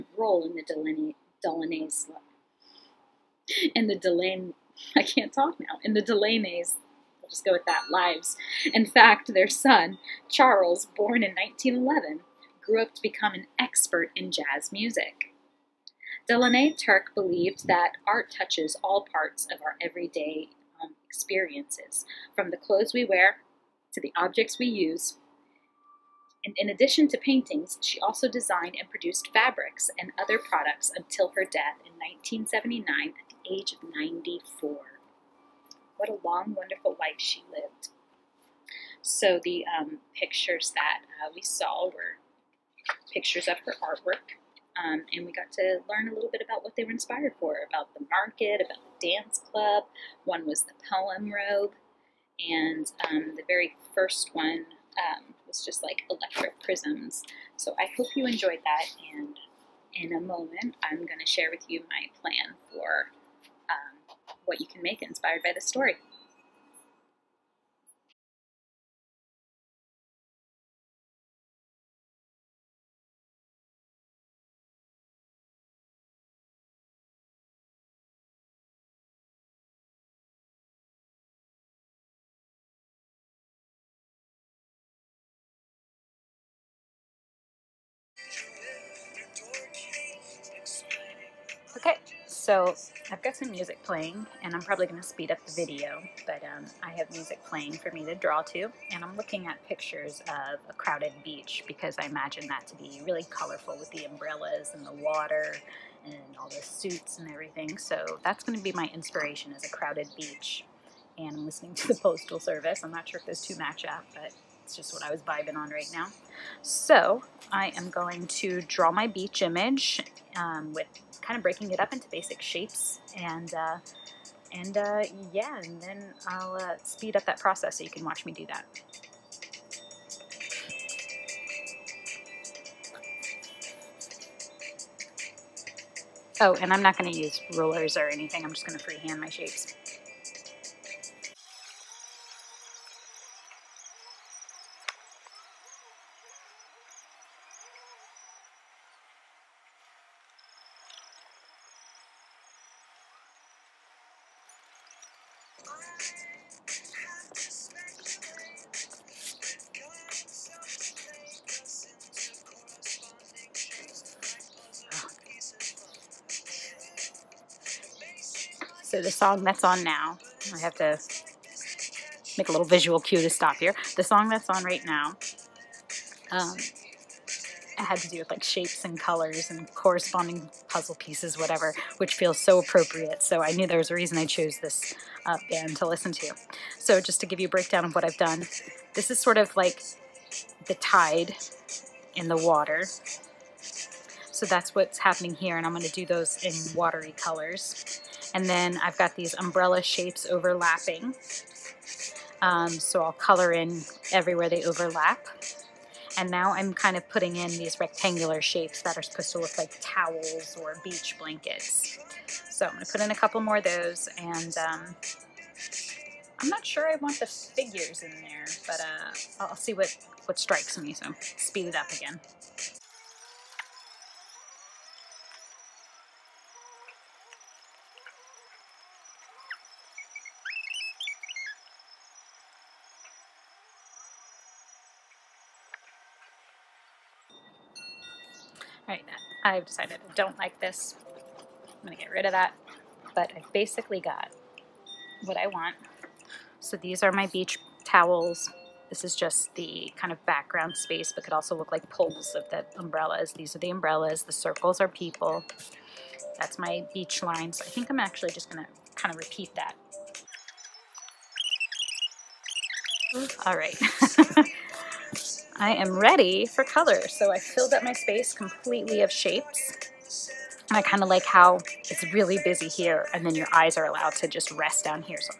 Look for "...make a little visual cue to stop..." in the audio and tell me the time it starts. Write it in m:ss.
2:52.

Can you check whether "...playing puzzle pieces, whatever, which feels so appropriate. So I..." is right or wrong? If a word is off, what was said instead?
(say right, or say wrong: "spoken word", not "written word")
wrong: "corresponding", not "playing".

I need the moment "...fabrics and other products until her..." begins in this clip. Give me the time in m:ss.
0:29.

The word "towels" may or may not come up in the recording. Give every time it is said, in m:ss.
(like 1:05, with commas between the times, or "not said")
3:29, 4:07.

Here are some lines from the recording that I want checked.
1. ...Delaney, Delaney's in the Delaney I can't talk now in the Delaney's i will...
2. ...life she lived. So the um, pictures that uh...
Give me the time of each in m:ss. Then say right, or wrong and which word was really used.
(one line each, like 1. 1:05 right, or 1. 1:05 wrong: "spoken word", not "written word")
1. 0:00 right
2. 0:36 right.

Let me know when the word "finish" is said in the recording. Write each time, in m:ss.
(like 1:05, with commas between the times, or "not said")
not said.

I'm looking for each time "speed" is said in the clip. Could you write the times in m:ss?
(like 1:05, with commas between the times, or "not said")
1:35, 2:06, 3:41.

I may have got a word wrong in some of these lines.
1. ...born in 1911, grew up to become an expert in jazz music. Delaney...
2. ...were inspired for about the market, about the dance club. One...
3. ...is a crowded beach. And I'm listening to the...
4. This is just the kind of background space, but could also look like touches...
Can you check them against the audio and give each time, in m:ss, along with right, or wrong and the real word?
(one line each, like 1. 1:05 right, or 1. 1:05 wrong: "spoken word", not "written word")
1. 0:10 right
2. 0:46 right
3. 1:49 right
4. 4:08 wrong: "poles", not "touches".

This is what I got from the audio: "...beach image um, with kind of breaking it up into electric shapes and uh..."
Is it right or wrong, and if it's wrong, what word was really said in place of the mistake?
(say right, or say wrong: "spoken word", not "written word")
wrong: "basic", not "electric".